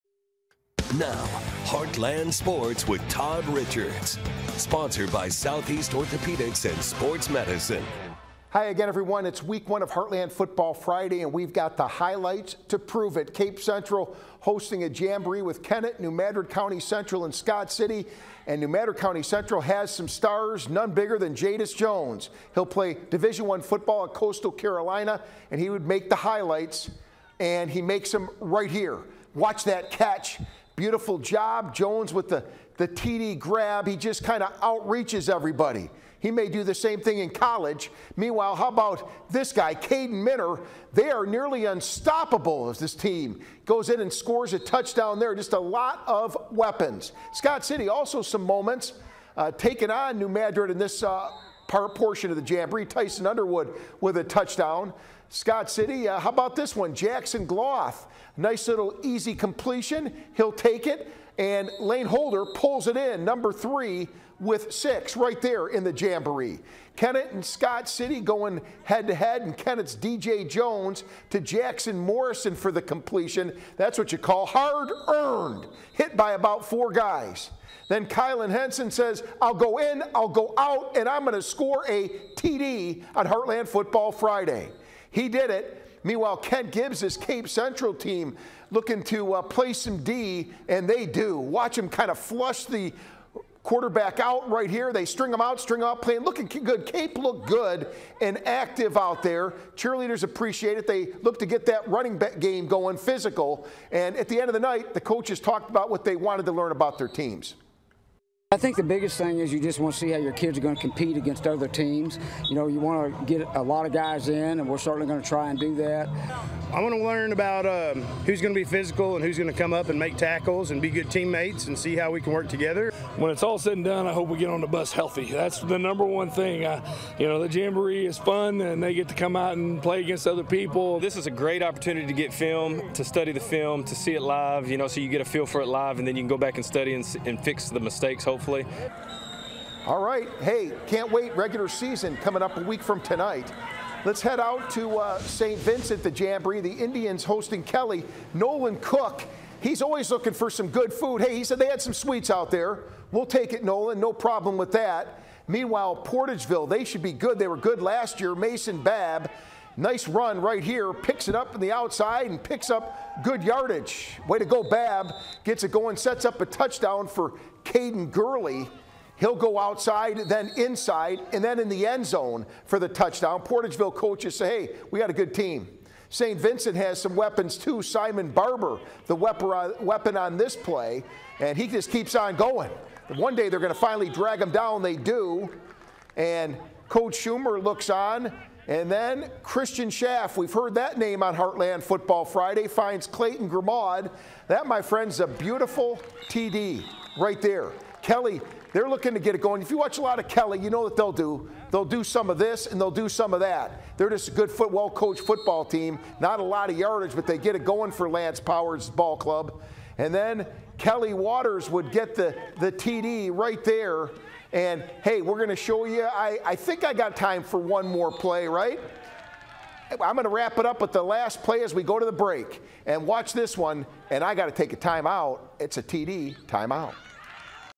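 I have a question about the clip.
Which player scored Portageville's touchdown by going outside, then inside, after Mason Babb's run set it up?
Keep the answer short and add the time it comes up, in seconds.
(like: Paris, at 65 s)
Caden Gurley, at 167 s.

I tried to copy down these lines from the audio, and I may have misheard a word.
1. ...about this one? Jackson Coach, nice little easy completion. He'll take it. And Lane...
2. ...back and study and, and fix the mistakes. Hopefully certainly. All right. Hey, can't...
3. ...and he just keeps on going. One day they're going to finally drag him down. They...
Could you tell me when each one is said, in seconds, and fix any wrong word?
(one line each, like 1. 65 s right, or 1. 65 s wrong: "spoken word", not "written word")
1. 56 s wrong: "Gloth", not "Coach"
2. 136 s wrong: "hopefully", not "certainly"
3. 181 s right.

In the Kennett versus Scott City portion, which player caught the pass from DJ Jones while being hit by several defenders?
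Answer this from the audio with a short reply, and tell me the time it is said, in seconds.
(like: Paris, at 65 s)
Jackson Morrison, at 71 s.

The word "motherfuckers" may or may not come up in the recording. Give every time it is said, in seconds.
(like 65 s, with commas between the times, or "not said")
not said.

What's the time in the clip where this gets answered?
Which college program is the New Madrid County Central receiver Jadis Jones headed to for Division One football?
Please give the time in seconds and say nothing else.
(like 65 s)
24 s.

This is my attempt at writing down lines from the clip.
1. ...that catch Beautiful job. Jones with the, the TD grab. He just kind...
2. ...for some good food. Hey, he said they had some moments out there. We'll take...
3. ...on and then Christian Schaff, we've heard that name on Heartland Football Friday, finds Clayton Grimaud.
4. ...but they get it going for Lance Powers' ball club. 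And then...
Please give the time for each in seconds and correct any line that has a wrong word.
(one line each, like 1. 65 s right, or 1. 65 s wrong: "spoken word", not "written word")
1. 29 s right
2. 150 s wrong: "sweets", not "moments"
3. 187 s right
4. 207 s right.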